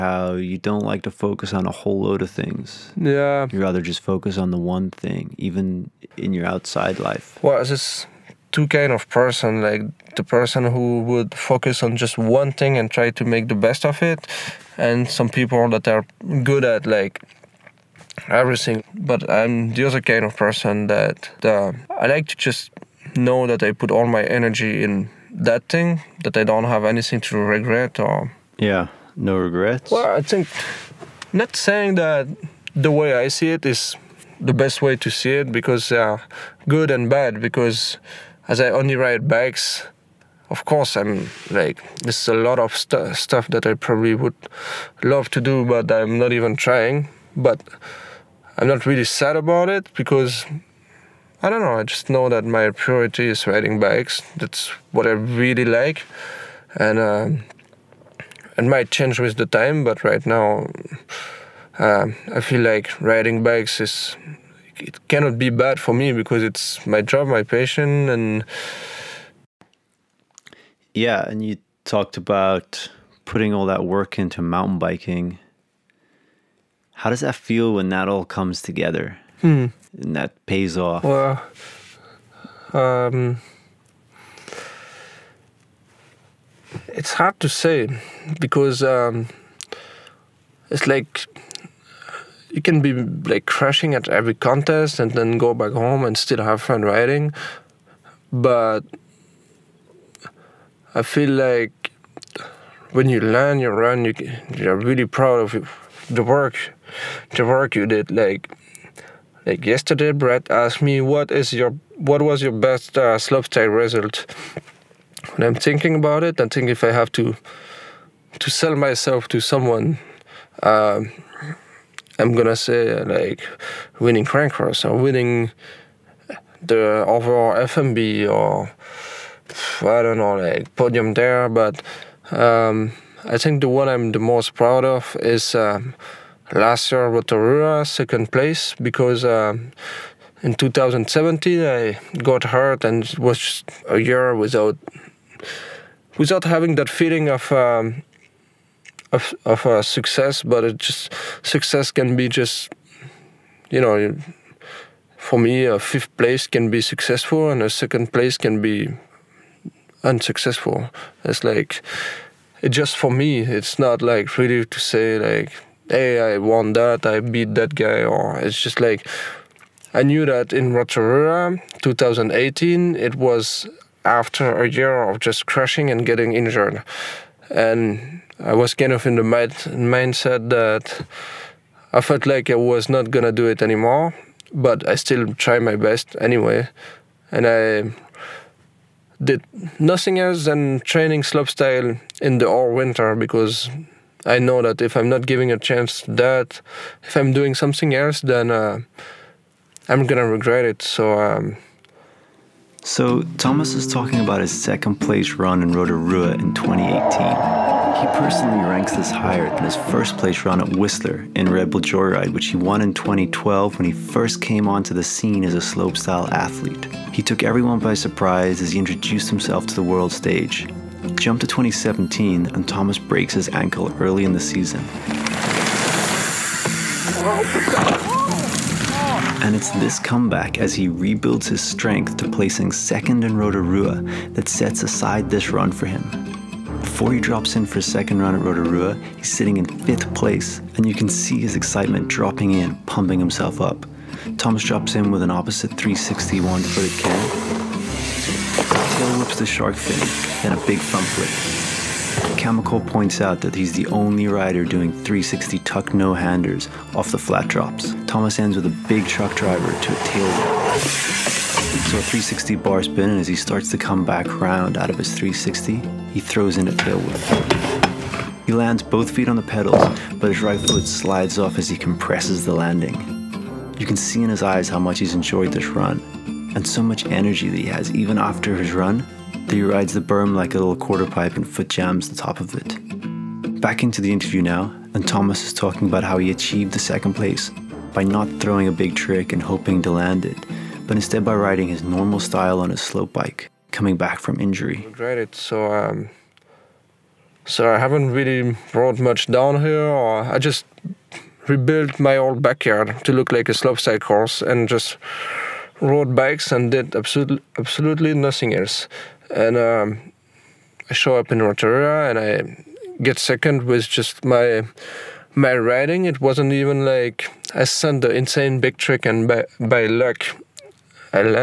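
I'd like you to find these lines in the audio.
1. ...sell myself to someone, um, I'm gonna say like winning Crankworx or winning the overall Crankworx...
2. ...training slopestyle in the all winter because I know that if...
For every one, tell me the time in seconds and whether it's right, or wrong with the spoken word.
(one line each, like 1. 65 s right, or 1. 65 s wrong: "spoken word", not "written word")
1. 118 s wrong: "FMB", not "Crankworx"
2. 190 s right.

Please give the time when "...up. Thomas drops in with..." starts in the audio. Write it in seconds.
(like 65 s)
243 s.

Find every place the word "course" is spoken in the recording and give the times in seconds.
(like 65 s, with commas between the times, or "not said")
40 s, 303 s.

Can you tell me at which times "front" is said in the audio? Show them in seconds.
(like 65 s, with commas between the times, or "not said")
250 s.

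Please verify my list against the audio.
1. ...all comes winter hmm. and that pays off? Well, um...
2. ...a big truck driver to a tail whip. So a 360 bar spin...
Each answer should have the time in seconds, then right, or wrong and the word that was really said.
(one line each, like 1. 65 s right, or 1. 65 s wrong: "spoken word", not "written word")
1. 78 s wrong: "together", not "winter"
2. 258 s right.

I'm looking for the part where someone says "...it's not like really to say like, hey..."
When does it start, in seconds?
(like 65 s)
163 s.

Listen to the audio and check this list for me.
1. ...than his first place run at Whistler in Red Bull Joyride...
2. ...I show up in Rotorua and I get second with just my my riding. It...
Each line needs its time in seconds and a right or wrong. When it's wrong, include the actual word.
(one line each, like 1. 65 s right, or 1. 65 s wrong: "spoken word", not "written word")
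1. 209 s right
2. 310 s right.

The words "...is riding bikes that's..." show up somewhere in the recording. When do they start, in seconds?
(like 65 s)
53 s.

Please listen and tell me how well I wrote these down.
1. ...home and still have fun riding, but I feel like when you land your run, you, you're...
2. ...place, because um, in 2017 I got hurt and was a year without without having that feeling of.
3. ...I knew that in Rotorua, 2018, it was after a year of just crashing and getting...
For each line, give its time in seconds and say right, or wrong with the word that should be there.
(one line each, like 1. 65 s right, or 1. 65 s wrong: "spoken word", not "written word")
1. 95 s right
2. 138 s right
3. 169 s right.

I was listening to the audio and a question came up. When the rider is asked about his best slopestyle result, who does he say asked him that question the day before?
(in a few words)
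Brett.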